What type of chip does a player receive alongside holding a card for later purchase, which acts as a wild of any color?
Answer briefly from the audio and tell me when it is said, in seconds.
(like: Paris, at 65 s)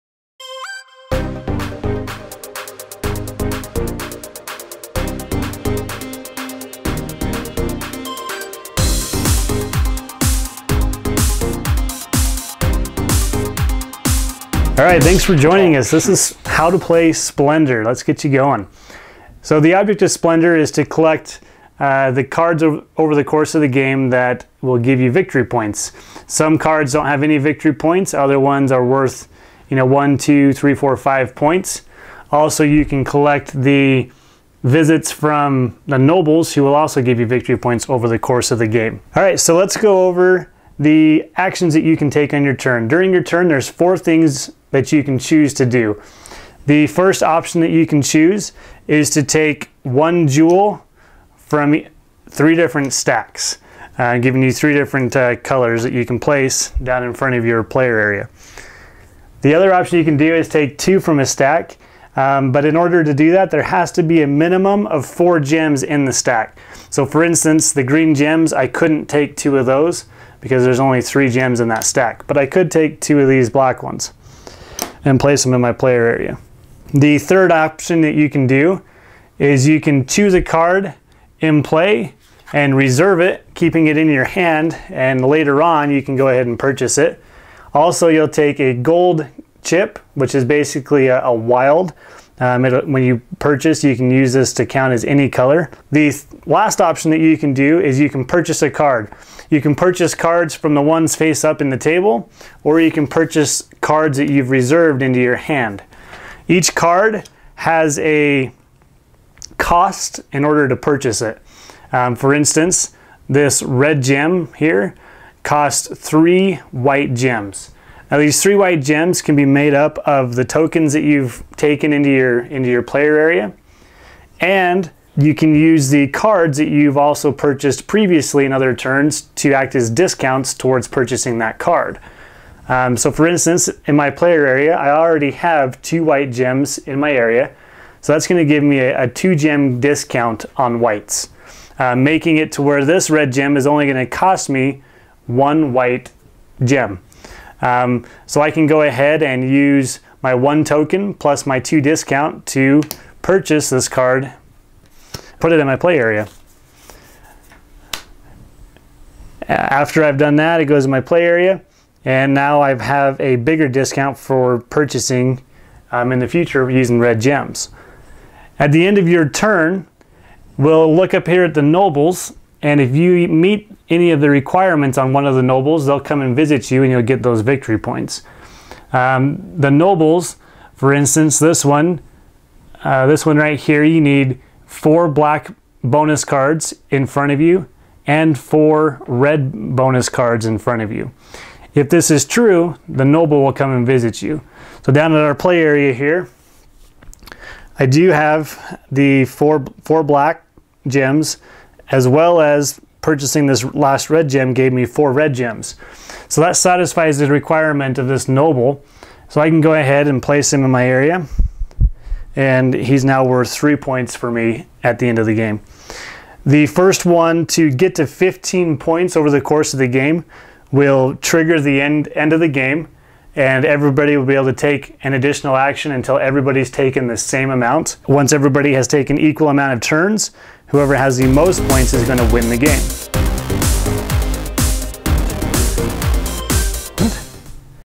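gold chip, at 88 s.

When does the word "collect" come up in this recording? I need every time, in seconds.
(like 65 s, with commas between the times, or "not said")
20 s, 33 s.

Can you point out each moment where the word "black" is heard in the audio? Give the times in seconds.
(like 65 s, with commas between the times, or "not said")
73 s, 185 s, 200 s.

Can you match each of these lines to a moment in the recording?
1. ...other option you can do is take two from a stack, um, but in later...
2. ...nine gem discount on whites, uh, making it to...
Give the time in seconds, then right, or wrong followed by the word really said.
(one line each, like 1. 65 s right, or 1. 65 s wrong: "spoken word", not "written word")
1. 59 s wrong: "order", not "later"
2. 139 s wrong: "two", not "nine".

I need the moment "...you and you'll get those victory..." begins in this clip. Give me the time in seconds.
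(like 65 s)
176 s.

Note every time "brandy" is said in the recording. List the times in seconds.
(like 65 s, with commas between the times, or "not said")
not said.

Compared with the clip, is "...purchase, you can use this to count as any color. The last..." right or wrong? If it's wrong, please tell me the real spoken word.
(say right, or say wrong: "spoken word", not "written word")
right.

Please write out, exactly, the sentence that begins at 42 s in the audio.
During your turn, there's four things that you can choose to do.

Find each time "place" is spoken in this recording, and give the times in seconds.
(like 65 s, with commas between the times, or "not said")
56 s, 75 s, 210 s.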